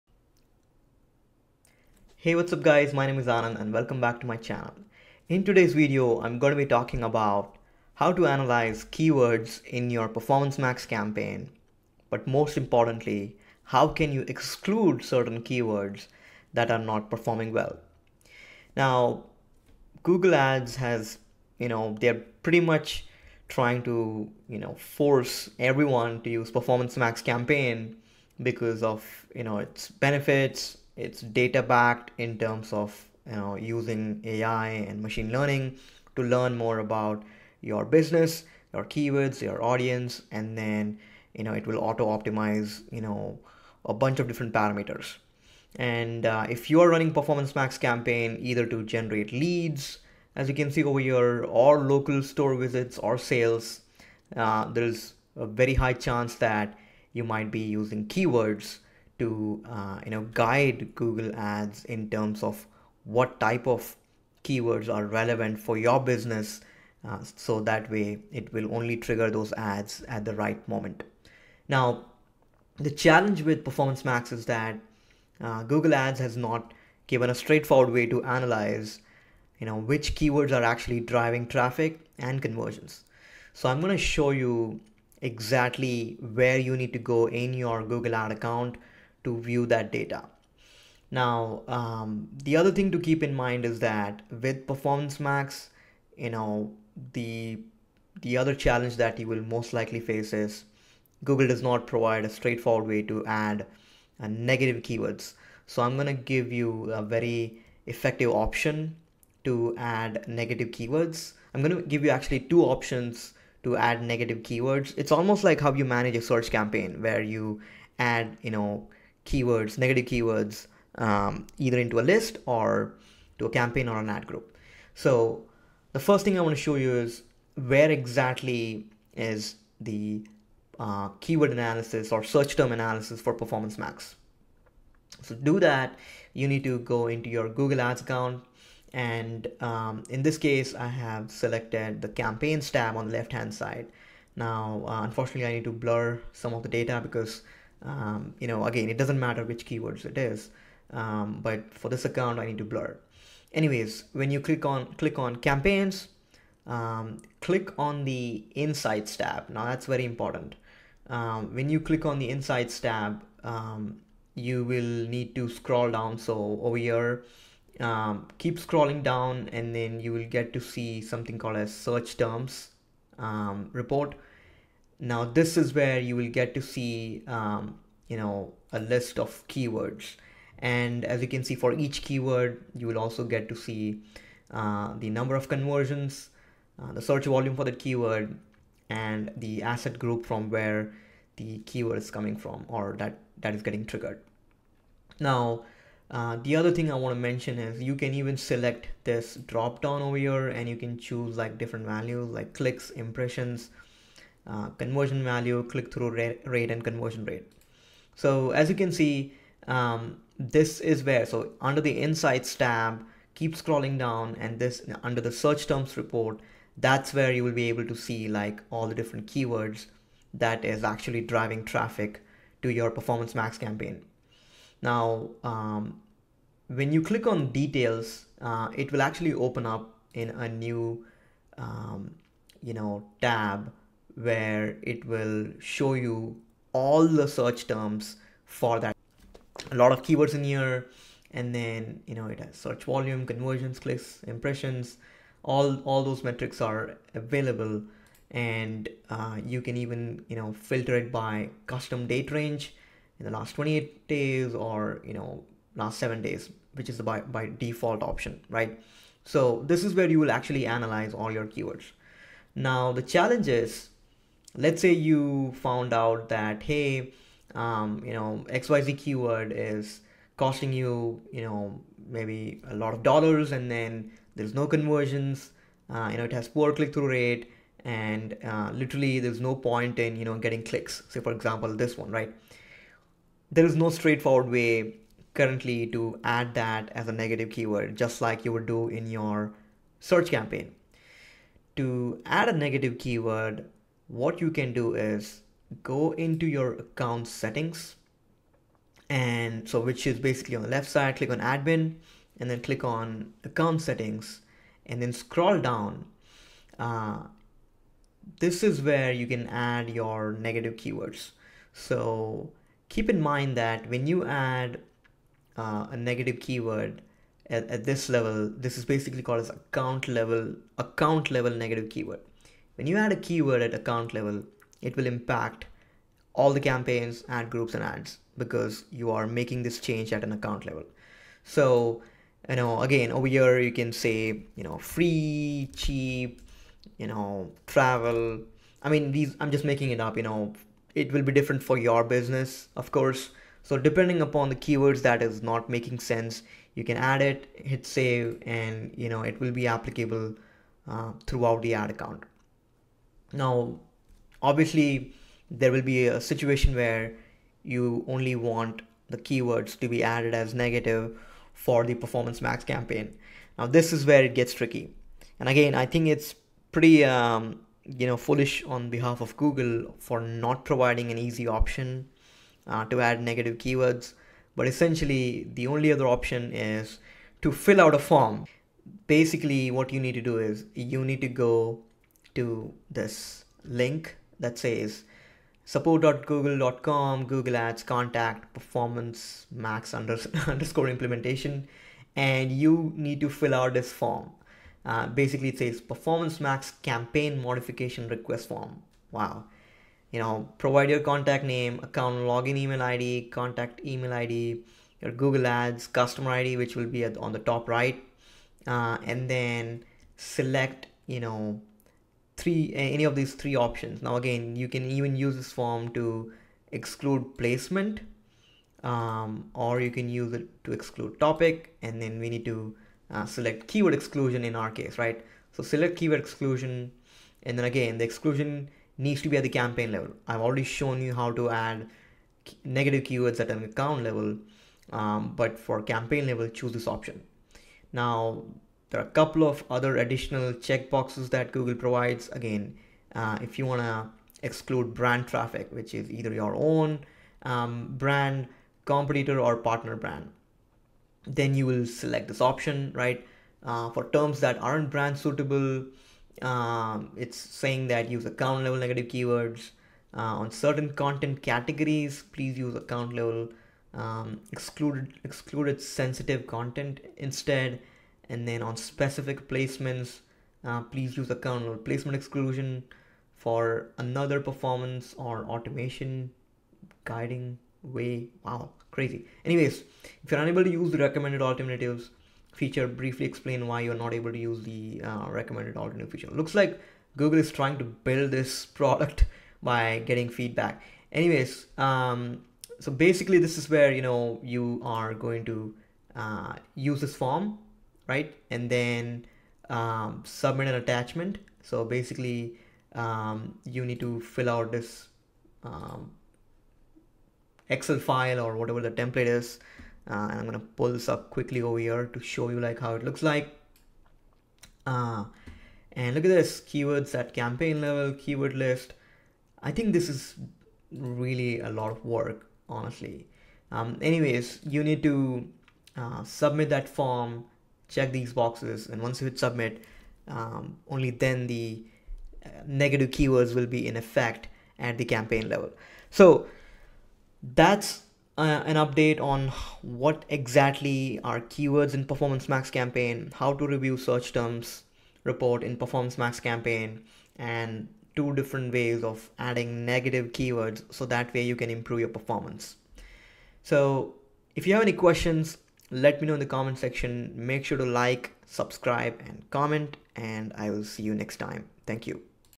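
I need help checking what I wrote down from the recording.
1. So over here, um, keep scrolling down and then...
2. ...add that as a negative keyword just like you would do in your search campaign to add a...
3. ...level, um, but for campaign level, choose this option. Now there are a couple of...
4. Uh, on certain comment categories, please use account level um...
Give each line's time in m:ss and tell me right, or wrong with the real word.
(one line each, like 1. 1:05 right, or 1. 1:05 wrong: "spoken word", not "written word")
1. 2:46 right
2. 4:46 right
3. 7:14 right
4. 7:40 wrong: "content", not "comment".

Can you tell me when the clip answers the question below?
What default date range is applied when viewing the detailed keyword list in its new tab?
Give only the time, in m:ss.
4:15.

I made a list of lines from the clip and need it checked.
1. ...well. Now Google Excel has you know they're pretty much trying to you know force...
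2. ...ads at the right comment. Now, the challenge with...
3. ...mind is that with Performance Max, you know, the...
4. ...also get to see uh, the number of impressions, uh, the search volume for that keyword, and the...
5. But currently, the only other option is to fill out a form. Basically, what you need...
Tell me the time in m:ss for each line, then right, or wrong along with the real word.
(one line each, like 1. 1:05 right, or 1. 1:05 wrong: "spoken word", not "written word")
1. 0:17 wrong: "Ads", not "Excel"
2. 1:09 wrong: "moment", not "comment"
3. 1:33 right
4. 3:02 wrong: "conversions", not "impressions"
5. 6:14 wrong: "essentially", not "currently".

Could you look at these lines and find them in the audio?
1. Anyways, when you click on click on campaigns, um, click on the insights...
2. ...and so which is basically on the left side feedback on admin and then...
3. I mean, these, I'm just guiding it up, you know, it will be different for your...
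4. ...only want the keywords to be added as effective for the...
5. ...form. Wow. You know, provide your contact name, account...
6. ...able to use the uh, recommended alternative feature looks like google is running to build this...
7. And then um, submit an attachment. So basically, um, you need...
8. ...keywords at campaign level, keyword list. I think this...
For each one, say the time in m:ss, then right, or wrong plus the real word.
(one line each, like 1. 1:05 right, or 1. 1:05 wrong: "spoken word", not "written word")
1. 2:33 right
2. 4:59 wrong: "click", not "feedback"
3. 5:38 wrong: "making", not "guiding"
4. 5:58 wrong: "negative", not "effective"
5. 6:38 right
6. 8:04 wrong: "trying", not "running"
7. 8:18 right
8. 8:36 right.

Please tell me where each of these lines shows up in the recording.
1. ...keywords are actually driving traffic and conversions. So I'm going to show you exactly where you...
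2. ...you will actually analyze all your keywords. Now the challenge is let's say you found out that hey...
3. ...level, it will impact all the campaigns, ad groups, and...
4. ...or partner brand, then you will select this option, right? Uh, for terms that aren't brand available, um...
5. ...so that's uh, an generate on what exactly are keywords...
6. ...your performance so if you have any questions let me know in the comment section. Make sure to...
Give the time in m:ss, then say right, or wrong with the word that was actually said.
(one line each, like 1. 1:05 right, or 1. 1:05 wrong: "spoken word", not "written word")
1. 1:20 right
2. 4:20 right
3. 5:24 right
4. 7:29 wrong: "suitable", not "available"
5. 8:56 wrong: "update", not "generate"
6. 9:11 right.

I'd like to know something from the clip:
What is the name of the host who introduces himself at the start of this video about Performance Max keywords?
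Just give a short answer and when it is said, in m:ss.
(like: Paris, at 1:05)
Anand, at 0:03.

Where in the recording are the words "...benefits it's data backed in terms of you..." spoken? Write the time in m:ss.
0:29.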